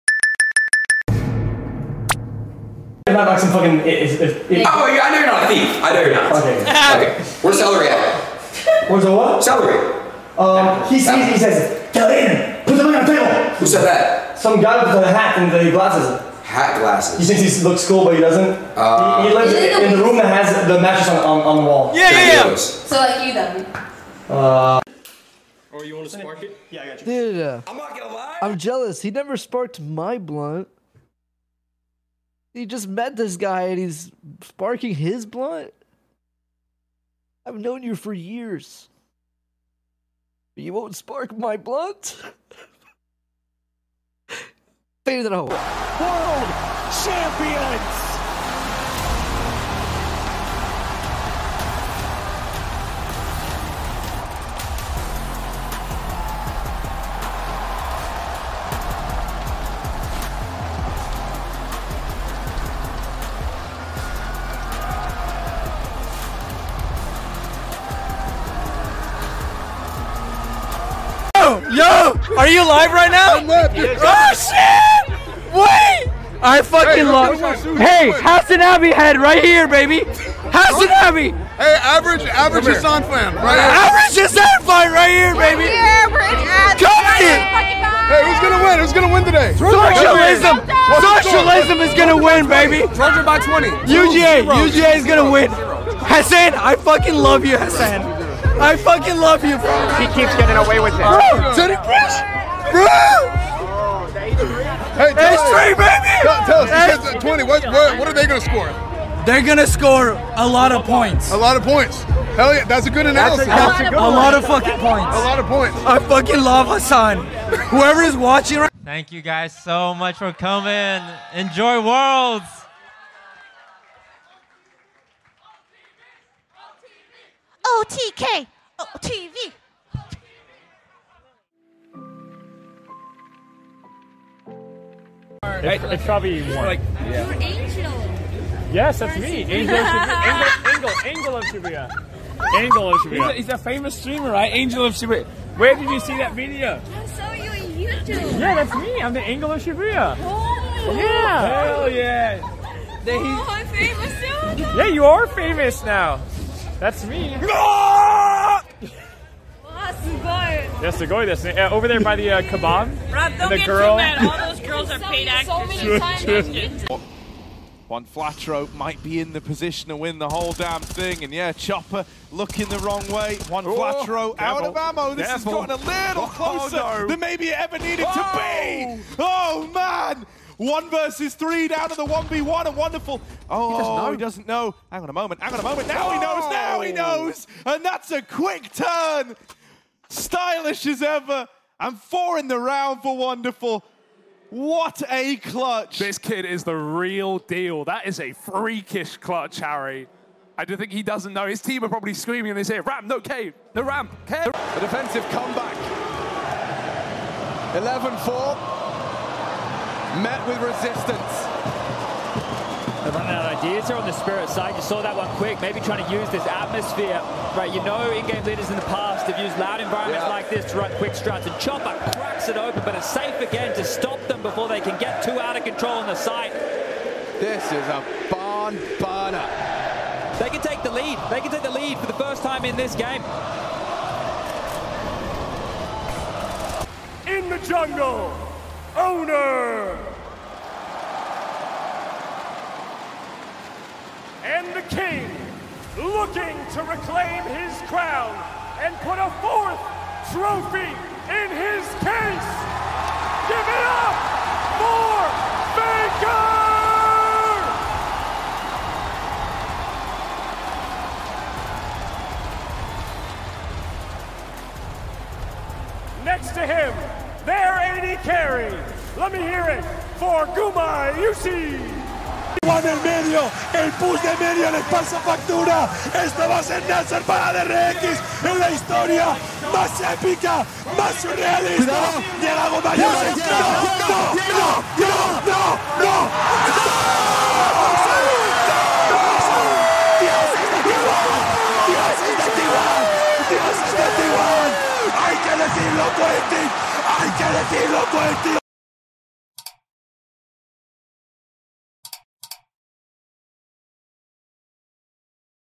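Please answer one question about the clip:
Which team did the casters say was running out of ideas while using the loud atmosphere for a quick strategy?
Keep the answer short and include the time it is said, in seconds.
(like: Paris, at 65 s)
Spirit, at 214 s.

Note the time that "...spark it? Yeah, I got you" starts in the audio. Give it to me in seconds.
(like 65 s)
26 s.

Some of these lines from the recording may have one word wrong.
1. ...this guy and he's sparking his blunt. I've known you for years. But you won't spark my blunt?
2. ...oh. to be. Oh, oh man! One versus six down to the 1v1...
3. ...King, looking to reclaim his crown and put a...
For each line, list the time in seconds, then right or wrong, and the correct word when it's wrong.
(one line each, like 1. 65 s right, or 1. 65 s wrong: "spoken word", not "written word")
1. 33 s right
2. 178 s wrong: "three", not "six"
3. 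244 s right.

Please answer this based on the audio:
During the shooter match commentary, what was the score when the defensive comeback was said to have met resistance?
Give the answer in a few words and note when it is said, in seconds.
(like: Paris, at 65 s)
11-4, at 207 s.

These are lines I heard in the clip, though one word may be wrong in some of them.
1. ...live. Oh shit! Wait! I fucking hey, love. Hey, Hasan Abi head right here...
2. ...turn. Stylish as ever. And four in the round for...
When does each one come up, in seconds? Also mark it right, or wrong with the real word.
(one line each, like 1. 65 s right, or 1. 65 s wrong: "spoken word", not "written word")
1. 73 s right
2. 188 s right.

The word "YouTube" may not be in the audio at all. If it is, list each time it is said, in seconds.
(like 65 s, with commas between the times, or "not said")
147 s.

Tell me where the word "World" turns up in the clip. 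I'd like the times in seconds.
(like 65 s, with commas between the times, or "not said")
45 s, 121 s.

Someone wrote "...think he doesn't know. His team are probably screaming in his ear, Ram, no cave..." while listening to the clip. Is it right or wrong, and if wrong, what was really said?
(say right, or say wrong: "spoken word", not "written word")
right.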